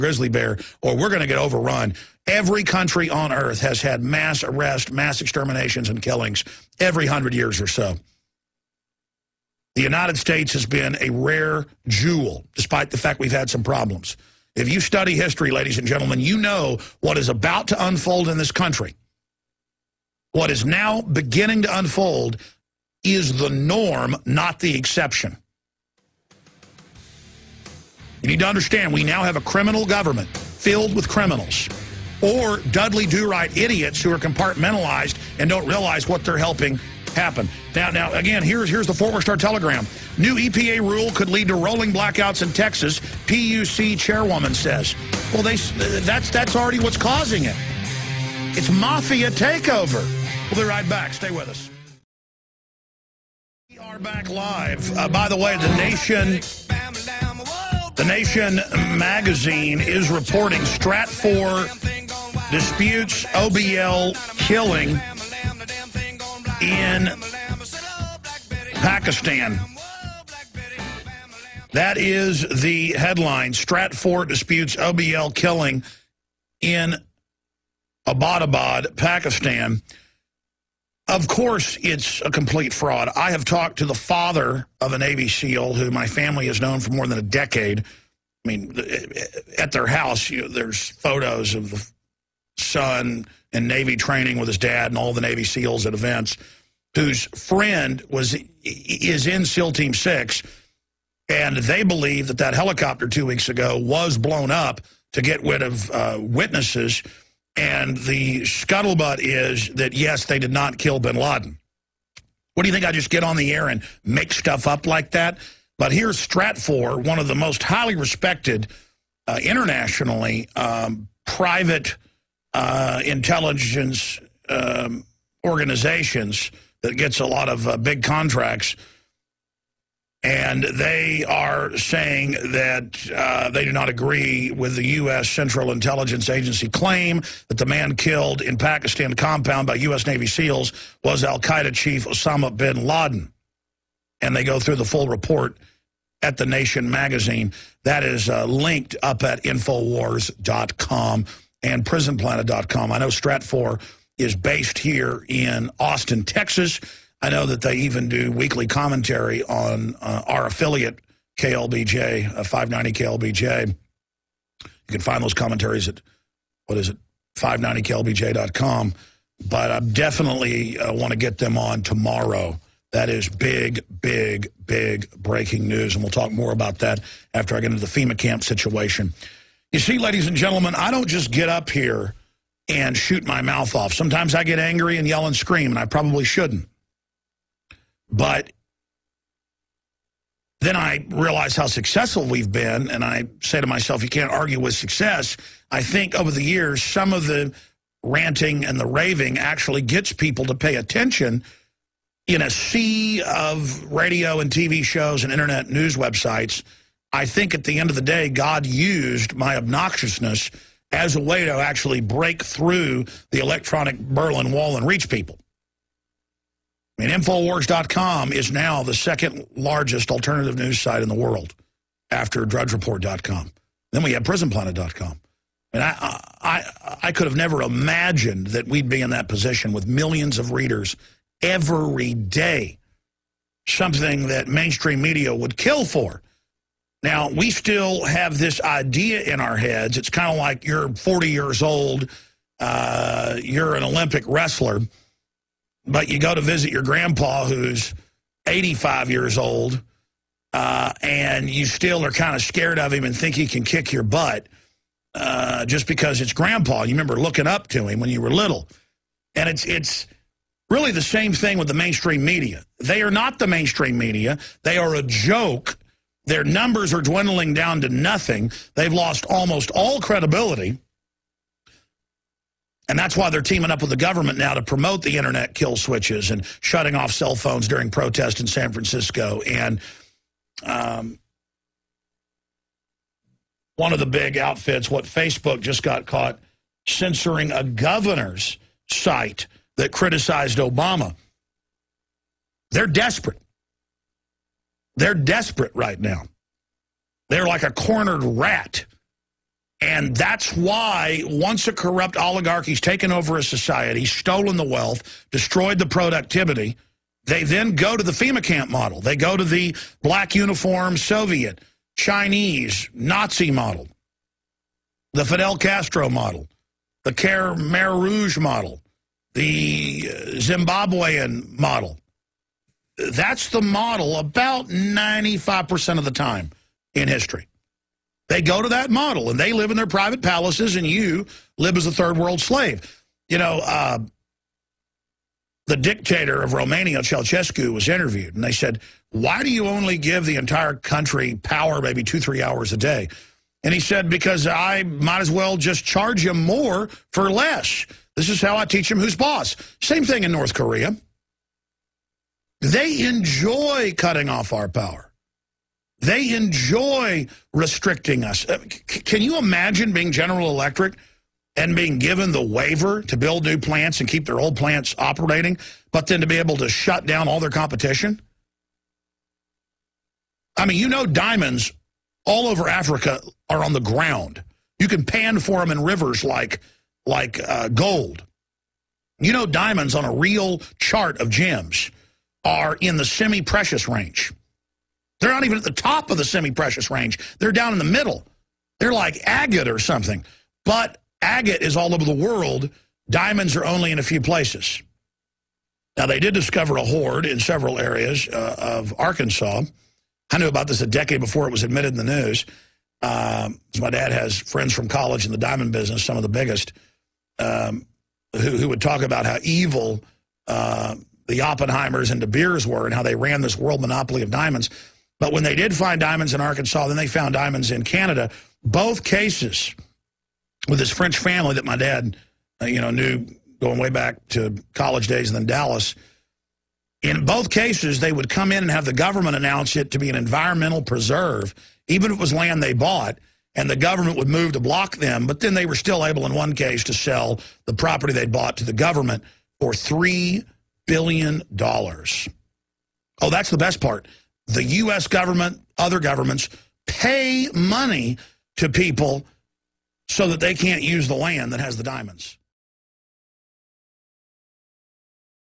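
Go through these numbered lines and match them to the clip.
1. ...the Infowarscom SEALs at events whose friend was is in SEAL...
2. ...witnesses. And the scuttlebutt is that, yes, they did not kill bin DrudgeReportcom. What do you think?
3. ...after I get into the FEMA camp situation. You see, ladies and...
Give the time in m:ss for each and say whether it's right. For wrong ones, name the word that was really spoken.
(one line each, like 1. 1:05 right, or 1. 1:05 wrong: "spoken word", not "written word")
1. 1:35 wrong: "Navy", not "Infowarscom"
2. 1:46 wrong: "Laden", not "DrudgeReportcom"
3. 2:57 right.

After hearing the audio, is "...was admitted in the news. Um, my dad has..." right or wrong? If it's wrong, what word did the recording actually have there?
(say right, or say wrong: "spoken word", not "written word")
right.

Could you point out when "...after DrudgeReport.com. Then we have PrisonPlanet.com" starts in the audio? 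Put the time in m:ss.
3:42.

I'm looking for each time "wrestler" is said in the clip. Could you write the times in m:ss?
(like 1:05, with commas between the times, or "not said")
4:04.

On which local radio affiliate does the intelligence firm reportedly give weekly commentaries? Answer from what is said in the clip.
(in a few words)
KLBJ 590.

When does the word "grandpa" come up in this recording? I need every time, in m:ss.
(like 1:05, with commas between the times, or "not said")
4:06, 4:16.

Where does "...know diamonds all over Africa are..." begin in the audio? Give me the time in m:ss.
6:10.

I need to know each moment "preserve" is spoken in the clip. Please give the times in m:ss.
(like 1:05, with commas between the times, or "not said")
7:10.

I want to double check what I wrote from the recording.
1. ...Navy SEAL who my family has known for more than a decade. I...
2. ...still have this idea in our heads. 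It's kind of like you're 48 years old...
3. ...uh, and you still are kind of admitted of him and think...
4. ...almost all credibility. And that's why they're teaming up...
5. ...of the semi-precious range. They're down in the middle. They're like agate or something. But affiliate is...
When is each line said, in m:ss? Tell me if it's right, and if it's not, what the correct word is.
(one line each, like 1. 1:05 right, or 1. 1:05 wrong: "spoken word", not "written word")
1. 1:24 right
2. 3:57 wrong: "40", not "48"
3. 4:10 wrong: "scared", not "admitted"
4. 4:29 right
5. 6:26 wrong: "agate", not "affiliate".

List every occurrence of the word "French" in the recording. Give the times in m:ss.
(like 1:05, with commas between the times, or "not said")
7:00.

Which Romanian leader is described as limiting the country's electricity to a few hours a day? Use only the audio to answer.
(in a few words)
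Ceausescu.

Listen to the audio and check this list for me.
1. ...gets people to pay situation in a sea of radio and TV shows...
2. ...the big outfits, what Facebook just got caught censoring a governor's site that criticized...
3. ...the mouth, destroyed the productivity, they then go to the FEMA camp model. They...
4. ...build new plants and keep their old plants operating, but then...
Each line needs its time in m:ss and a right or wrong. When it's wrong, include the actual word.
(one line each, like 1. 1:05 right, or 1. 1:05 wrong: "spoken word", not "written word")
1. 3:19 wrong: "attention", not "situation"
2. 4:43 right
3. 5:04 wrong: "wealth", not "mouth"
4. 6:03 right.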